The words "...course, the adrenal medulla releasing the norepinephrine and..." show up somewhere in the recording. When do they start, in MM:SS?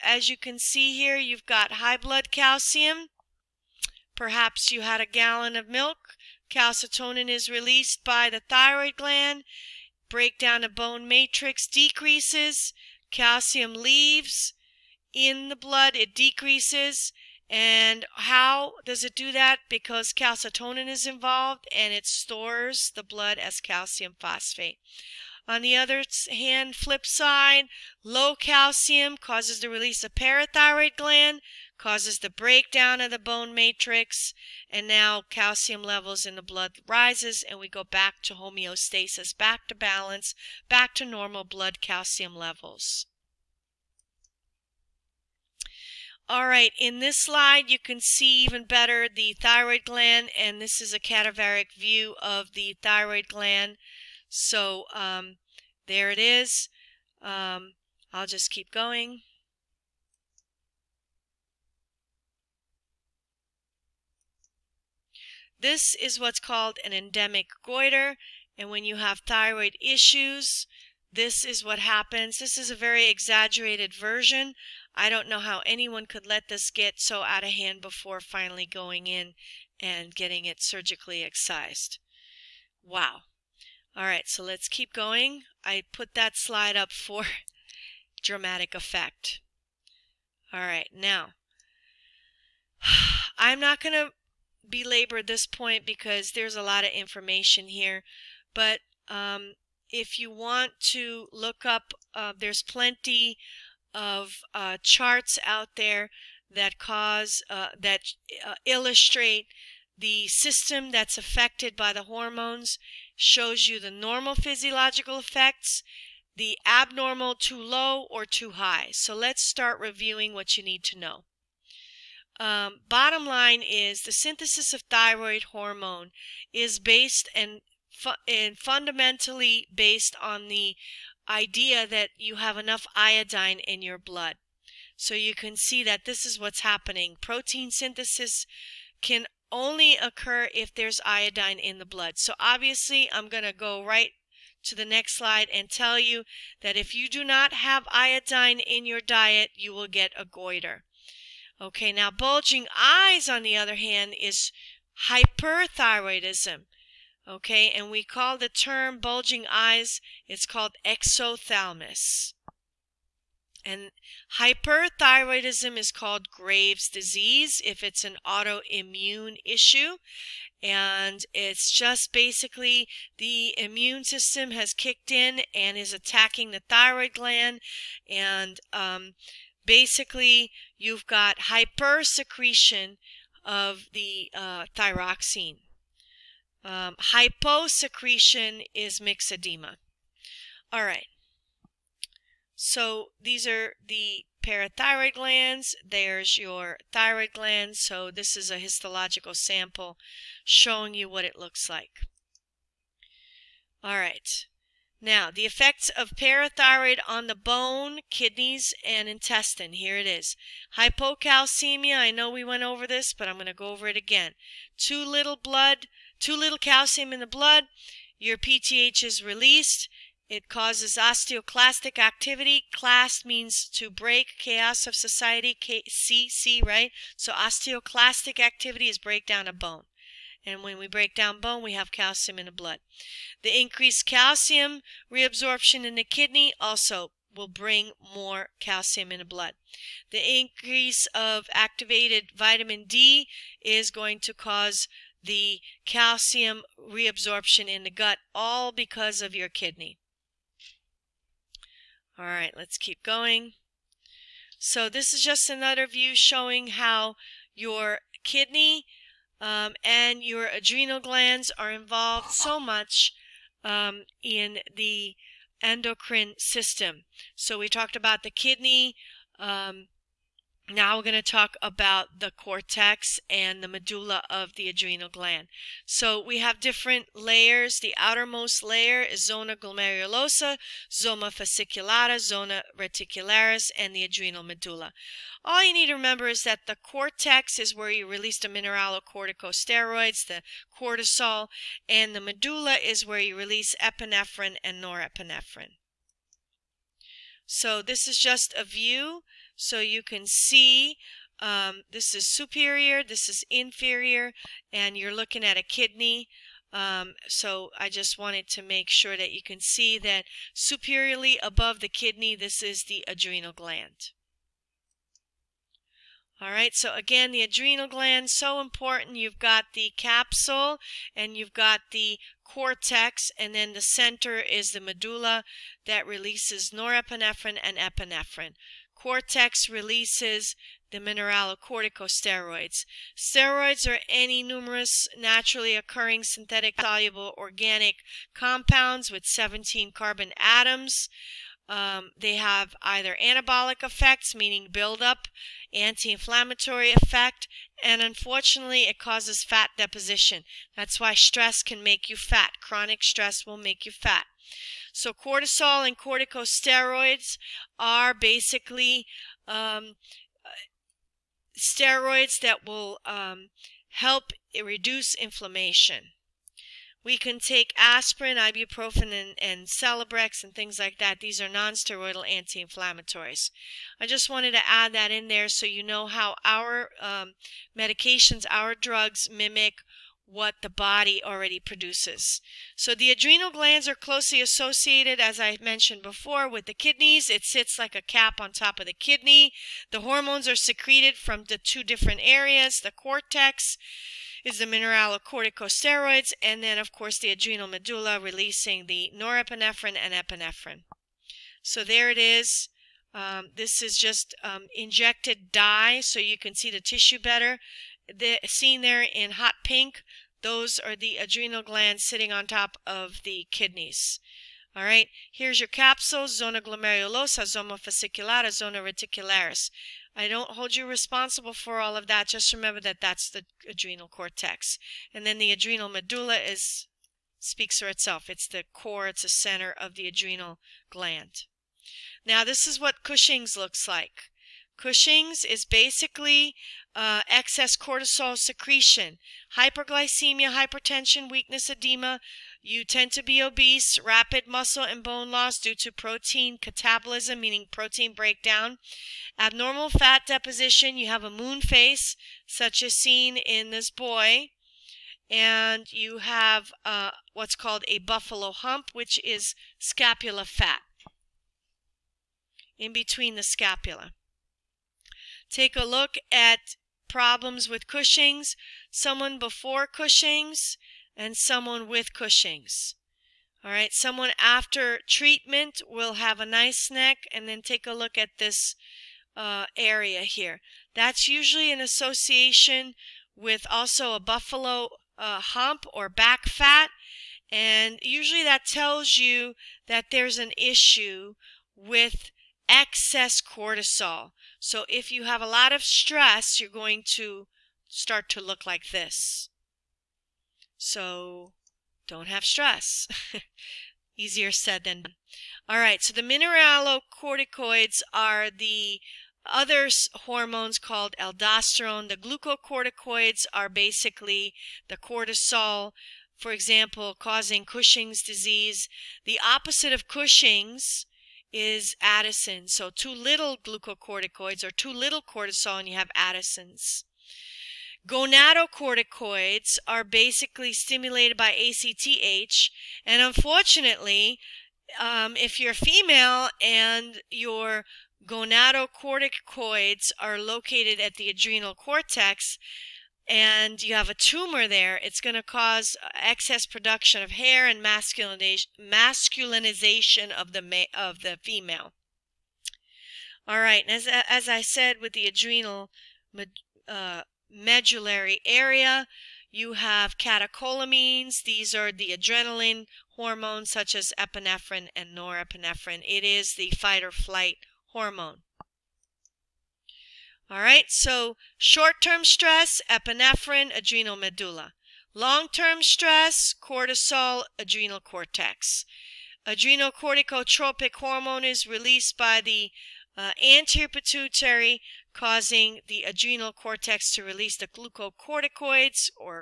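06:36.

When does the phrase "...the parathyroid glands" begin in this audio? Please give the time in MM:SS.
03:13.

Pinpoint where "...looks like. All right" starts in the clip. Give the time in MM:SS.
03:21.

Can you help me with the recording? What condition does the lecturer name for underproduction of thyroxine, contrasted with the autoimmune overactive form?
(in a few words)
myxedema.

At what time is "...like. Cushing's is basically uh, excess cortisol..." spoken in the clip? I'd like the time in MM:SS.
07:13.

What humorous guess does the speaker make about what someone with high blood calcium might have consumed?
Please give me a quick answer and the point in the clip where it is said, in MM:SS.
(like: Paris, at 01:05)
a gallon of milk, at 00:05.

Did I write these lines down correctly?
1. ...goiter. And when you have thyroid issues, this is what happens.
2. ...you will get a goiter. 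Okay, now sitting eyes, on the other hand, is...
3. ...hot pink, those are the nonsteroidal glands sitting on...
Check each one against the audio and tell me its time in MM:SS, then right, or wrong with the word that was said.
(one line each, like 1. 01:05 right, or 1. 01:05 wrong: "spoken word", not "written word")
1. 01:07 right
2. 02:29 wrong: "bulging", not "sitting"
3. 06:49 wrong: "adrenal", not "nonsteroidal".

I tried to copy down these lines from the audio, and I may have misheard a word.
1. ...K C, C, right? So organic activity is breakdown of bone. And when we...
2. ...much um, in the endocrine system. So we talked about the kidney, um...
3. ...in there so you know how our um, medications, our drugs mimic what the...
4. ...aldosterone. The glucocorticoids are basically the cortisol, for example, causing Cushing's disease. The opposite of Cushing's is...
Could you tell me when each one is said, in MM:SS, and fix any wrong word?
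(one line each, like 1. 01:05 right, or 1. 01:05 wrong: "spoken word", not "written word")
1. 03:45 wrong: "osteoclastic", not "organic"
2. 04:22 right
3. 06:15 right
4. 08:31 right.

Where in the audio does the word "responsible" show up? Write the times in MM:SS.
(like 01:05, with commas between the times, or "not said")
07:00.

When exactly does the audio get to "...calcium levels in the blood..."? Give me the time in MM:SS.
00:35.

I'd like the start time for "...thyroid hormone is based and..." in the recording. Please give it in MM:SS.
02:04.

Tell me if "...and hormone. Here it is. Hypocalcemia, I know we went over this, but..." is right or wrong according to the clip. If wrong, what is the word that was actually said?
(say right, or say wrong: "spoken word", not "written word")
wrong: "intestine", not "hormone".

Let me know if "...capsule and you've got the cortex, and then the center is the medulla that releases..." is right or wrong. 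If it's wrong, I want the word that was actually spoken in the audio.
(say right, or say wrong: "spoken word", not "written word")
right.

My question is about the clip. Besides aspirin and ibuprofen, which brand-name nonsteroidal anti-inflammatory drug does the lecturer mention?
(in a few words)
Celebrex.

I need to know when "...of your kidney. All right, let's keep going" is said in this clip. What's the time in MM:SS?
04:09.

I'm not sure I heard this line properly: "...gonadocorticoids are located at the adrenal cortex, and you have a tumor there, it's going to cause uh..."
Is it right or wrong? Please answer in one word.
right.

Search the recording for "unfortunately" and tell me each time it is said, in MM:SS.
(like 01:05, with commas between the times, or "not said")
05:48, 08:53.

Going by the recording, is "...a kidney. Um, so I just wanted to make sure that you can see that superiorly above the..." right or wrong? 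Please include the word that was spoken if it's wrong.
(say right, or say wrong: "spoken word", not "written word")
right.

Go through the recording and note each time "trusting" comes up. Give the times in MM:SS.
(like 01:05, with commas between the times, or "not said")
not said.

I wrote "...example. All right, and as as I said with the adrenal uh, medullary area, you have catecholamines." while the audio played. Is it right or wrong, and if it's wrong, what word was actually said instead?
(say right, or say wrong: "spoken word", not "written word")
wrong: "female", not "example".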